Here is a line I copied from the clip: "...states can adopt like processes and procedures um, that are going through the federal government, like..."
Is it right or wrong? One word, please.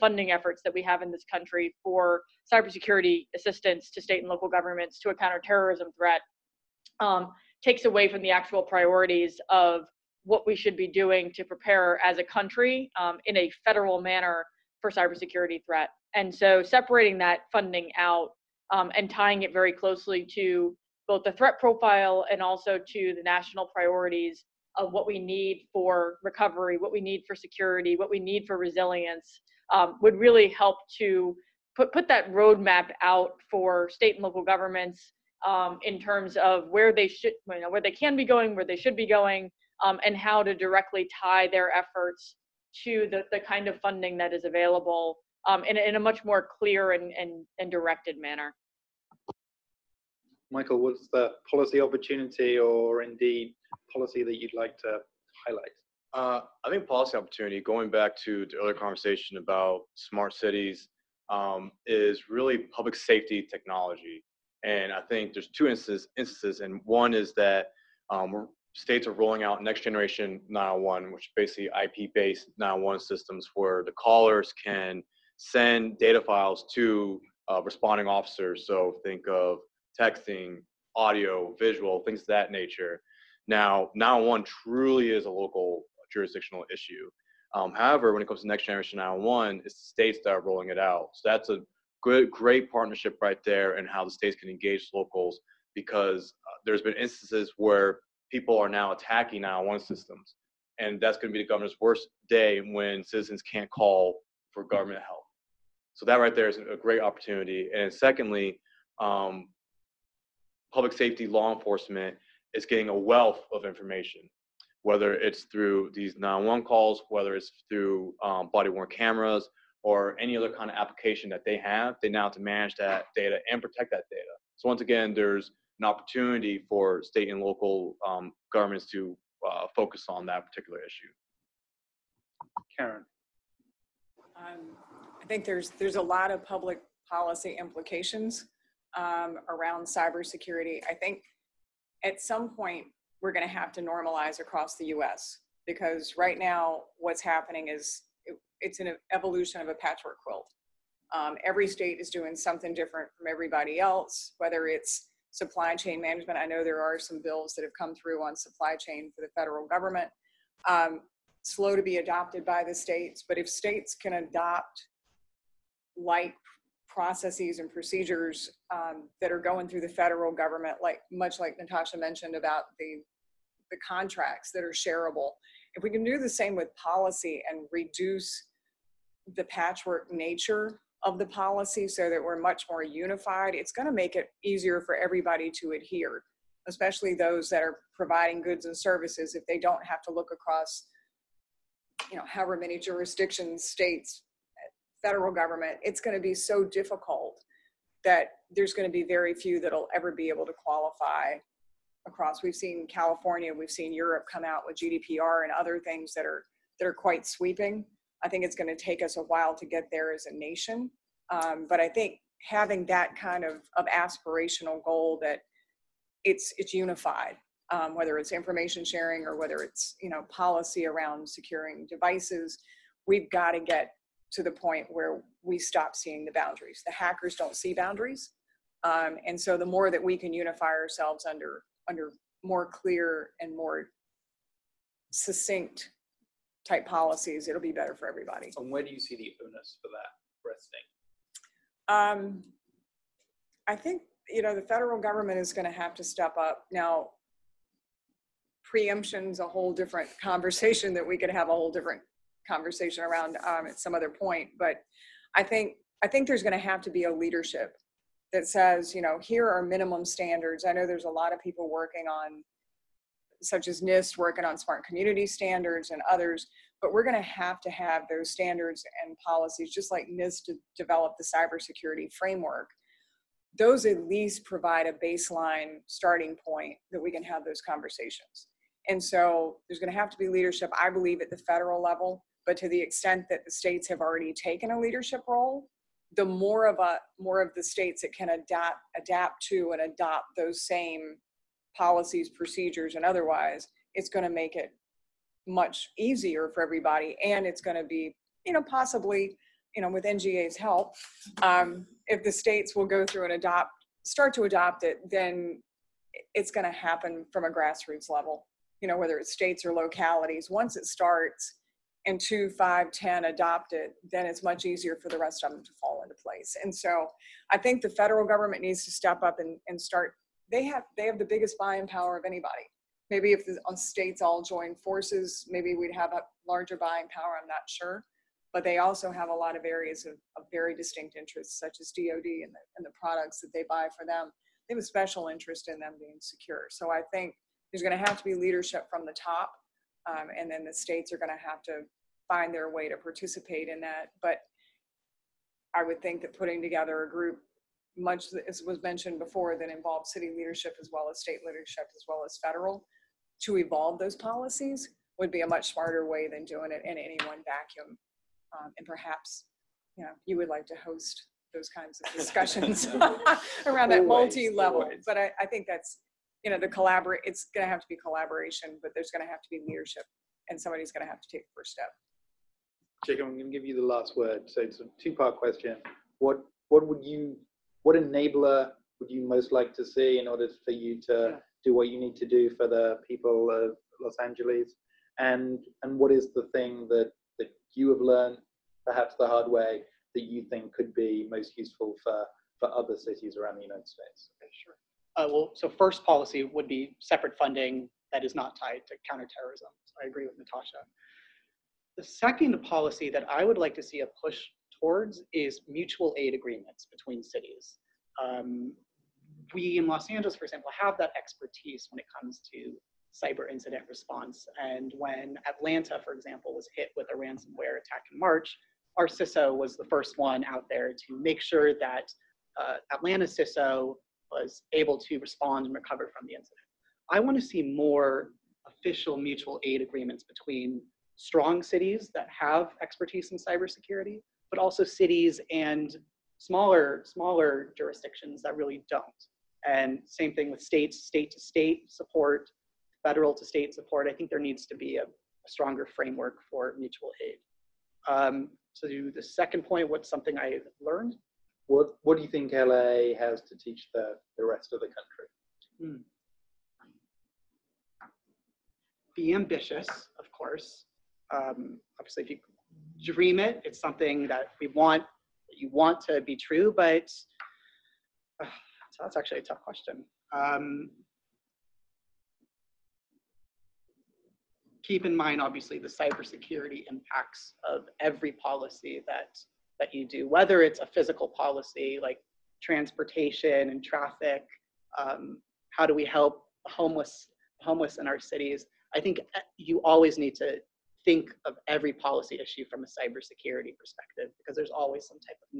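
right.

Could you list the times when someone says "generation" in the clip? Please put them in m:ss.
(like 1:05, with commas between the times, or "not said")
1:09, 1:28.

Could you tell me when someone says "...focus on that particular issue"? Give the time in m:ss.
2:09.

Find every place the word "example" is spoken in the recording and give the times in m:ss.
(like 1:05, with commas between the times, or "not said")
6:50, 6:56.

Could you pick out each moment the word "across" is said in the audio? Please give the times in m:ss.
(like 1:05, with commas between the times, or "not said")
2:24, 3:10, 3:22.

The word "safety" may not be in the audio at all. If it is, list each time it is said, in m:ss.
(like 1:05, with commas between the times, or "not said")
1:02, 1:50.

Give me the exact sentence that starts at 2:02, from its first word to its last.
They now have to manage that data and protect that data.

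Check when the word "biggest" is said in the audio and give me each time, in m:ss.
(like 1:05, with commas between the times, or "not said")
5:21.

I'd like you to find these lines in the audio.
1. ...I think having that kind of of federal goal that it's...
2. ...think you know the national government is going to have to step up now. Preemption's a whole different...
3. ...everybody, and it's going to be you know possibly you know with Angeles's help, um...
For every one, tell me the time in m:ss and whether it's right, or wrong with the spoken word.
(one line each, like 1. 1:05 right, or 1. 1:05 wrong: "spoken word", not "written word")
1. 3:31 wrong: "aspirational", not "federal"
2. 4:03 wrong: "federal", not "national"
3. 4:56 wrong: "NGA", not "Angeles".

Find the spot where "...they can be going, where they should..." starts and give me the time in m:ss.
0:37.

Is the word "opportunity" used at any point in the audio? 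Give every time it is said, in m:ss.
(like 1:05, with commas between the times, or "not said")
0:51, 0:57, 1:46, 2:05.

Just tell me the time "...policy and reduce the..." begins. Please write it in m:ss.
2:56.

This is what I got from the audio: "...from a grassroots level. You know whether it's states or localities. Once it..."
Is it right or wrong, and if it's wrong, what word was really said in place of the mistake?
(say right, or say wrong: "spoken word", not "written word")
right.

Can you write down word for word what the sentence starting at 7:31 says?
What What do you think LA has to teach the the rest of the country?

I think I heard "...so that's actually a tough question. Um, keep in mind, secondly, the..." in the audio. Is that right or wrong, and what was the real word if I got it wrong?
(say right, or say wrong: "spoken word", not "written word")
wrong: "obviously", not "secondly".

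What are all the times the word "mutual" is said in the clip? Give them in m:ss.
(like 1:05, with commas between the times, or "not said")
6:45, 7:09, 7:26.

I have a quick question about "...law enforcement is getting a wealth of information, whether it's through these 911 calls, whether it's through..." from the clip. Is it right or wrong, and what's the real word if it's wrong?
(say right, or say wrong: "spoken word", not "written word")
right.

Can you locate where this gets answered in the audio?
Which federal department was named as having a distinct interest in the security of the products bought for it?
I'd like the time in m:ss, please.
5:31.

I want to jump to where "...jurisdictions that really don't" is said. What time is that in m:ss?
7:17.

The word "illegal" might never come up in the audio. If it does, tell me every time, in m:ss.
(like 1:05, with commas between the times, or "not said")
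not said.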